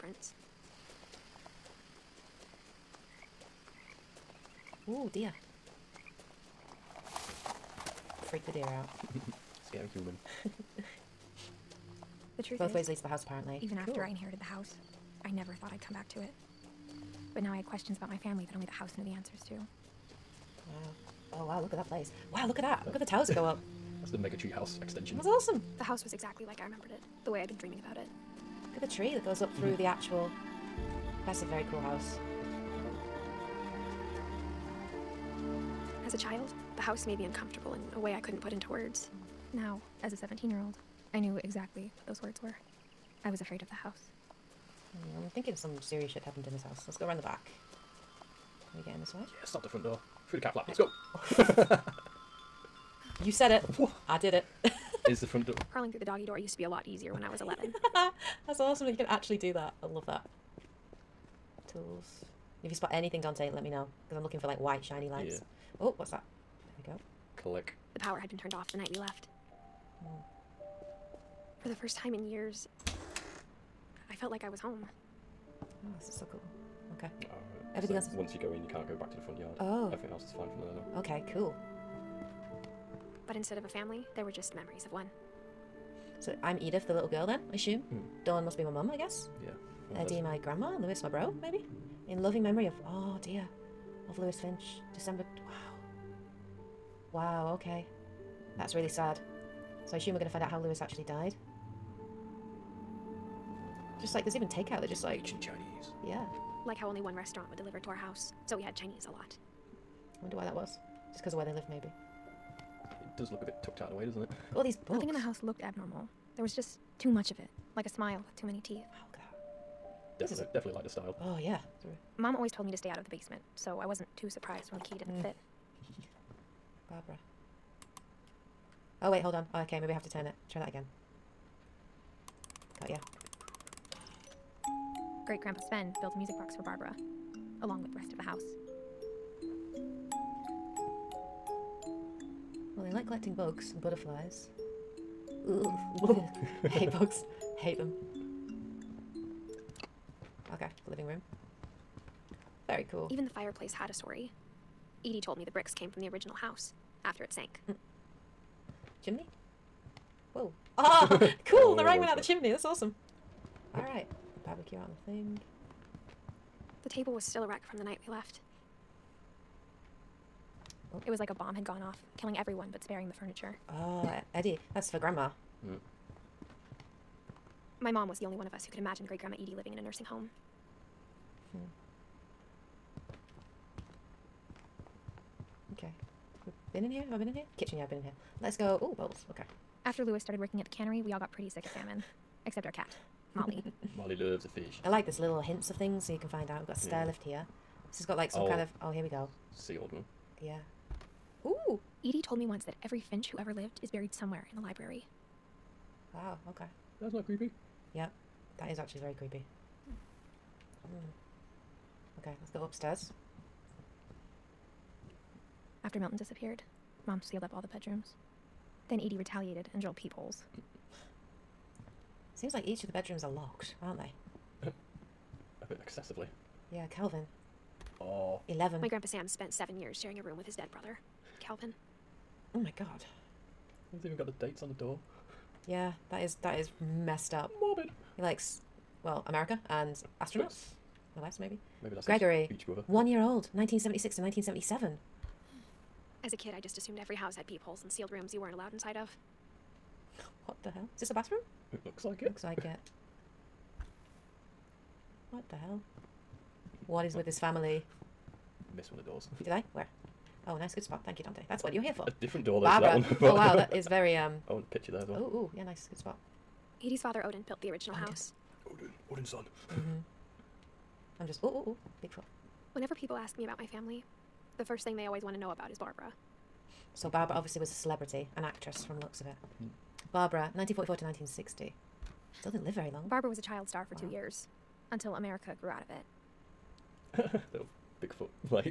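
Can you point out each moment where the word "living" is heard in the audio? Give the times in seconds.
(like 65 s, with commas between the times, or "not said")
150 s, 179 s.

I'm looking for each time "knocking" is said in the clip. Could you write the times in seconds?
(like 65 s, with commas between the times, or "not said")
not said.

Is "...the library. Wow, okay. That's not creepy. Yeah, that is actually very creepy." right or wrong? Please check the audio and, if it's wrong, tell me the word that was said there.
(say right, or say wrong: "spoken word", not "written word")
right.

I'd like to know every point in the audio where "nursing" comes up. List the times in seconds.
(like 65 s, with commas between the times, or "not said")
179 s.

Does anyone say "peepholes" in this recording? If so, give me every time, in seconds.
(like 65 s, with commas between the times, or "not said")
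219 s, 247 s.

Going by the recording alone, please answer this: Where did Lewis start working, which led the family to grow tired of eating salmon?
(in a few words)
The cannery.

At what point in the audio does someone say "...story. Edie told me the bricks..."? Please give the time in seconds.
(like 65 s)
153 s.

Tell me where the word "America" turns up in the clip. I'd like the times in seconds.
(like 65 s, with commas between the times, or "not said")
239 s, 285 s.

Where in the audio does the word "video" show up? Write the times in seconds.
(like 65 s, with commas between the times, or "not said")
not said.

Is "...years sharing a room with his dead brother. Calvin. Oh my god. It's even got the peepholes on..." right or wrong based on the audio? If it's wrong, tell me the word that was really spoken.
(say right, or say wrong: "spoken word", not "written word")
wrong: "dates", not "peepholes".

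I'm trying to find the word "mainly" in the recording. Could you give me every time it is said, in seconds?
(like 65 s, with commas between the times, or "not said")
not said.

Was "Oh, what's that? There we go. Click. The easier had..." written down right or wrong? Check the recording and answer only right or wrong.
wrong.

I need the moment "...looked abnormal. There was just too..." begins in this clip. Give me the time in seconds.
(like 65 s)
115 s.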